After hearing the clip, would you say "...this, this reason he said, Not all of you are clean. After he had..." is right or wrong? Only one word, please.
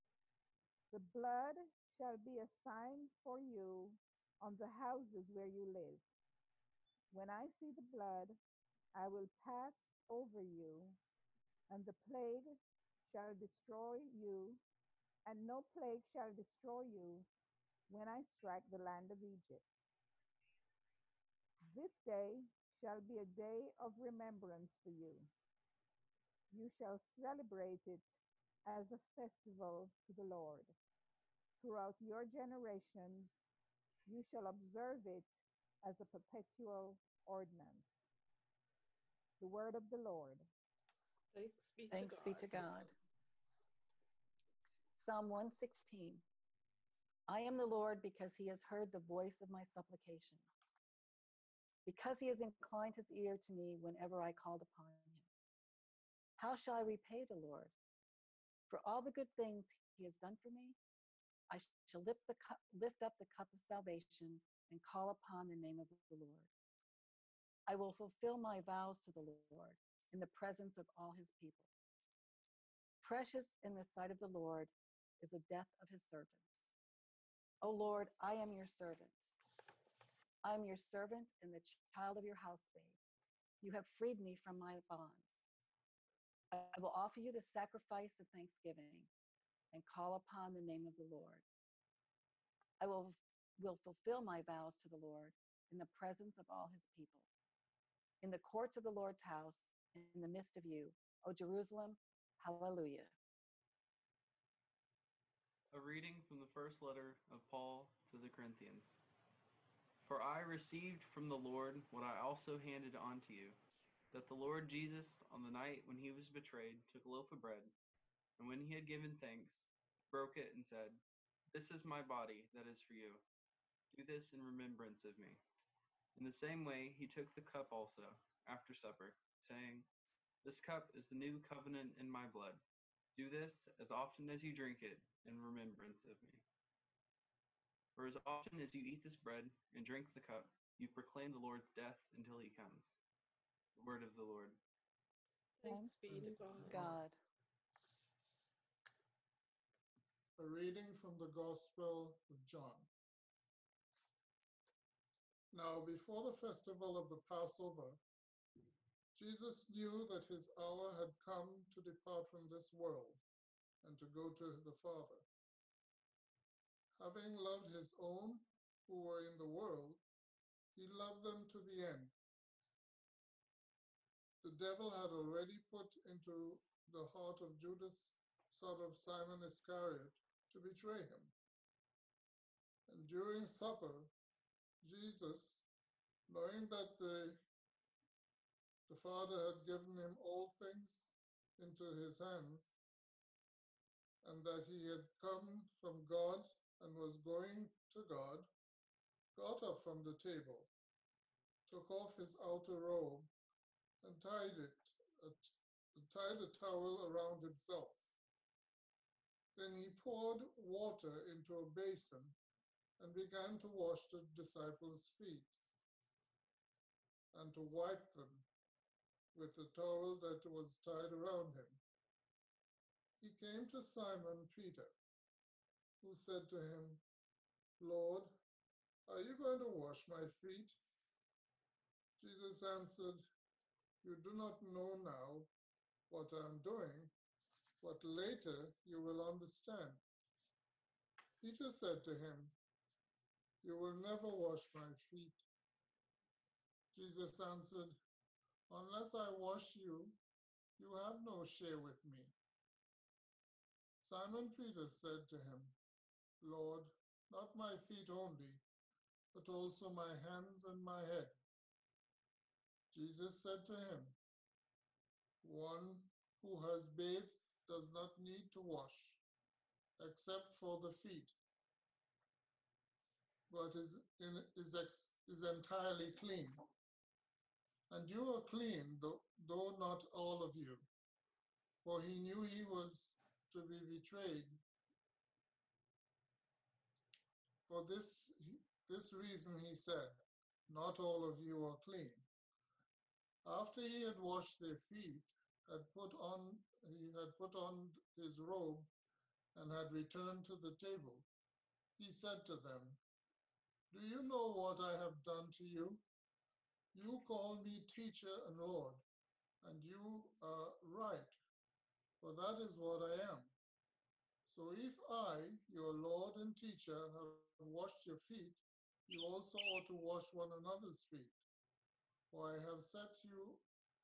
right.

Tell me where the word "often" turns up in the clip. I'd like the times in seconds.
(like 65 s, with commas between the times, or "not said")
133 s, 138 s.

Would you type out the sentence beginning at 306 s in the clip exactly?
You call me teacher and Lord, and you are right, for that is what I am.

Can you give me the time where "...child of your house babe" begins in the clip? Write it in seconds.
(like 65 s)
81 s.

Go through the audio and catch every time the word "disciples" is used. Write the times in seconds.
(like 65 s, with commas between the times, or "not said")
214 s.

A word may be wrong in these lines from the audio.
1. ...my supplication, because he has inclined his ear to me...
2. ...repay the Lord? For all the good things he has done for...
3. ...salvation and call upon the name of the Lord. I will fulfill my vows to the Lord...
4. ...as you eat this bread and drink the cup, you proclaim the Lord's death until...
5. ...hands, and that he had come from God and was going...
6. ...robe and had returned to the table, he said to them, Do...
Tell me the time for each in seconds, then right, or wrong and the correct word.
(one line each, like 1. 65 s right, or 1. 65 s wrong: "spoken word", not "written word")
1. 49 s right
2. 56 s right
3. 63 s right
4. 138 s right
5. 192 s right
6. 298 s right.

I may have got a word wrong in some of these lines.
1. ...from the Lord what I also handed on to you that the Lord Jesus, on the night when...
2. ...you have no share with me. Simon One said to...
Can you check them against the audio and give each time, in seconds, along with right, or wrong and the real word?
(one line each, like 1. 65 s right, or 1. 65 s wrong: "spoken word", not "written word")
1. 111 s right
2. 250 s wrong: "Peter", not "One".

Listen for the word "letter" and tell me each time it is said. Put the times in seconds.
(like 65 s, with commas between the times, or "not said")
106 s.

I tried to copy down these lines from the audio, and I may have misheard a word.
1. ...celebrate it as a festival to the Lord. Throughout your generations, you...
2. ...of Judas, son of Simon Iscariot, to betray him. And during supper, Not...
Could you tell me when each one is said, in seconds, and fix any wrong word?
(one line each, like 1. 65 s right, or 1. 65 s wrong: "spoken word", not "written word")
1. 26 s right
2. 177 s wrong: "Jesus", not "Not".